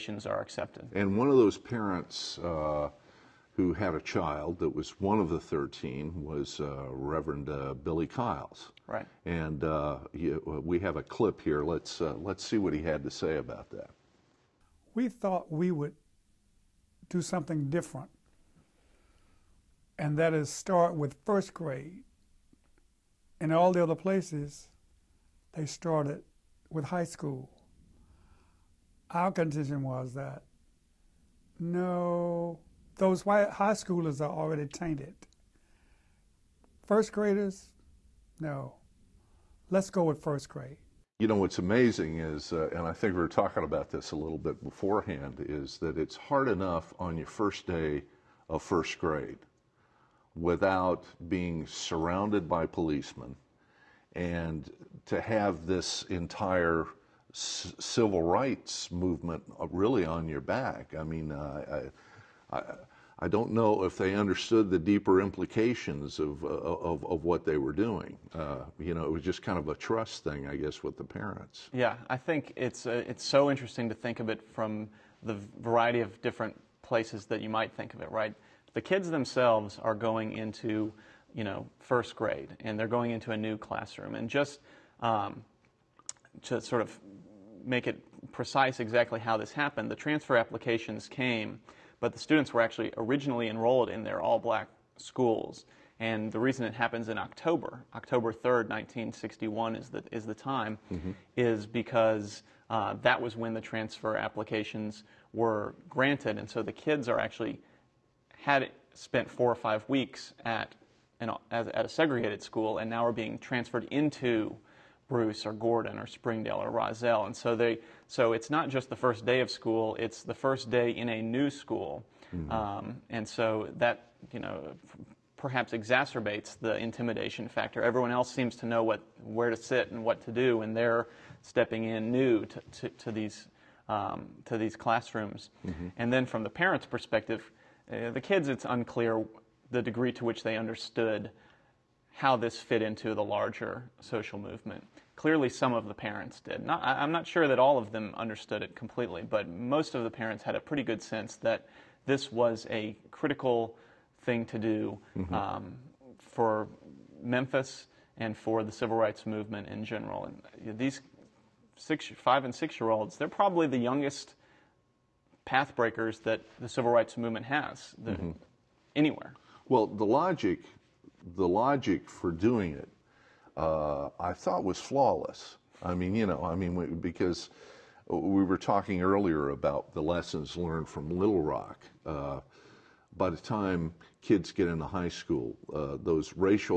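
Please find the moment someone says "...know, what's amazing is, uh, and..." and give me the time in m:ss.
0:41.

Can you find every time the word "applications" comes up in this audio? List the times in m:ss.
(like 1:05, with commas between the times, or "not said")
1:30, 1:44.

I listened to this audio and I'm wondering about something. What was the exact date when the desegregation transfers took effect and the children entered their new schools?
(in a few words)
October 3rd, 1961.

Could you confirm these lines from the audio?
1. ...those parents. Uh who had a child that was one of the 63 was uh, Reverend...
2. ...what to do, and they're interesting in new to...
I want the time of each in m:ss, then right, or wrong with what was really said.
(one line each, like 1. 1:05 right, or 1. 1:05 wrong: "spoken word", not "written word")
1. 0:01 wrong: "13", not "63"
2. 2:10 wrong: "stepping", not "interesting".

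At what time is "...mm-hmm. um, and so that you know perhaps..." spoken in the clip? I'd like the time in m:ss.
2:02.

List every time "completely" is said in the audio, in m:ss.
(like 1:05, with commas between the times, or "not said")
2:28.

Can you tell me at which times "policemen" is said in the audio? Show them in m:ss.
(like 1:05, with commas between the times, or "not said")
0:52.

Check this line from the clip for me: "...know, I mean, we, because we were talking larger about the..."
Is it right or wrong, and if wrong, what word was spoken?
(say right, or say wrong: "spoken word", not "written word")
wrong: "earlier", not "larger".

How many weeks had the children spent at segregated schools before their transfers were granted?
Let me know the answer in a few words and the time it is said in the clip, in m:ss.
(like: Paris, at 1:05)
4 or 5, at 1:49.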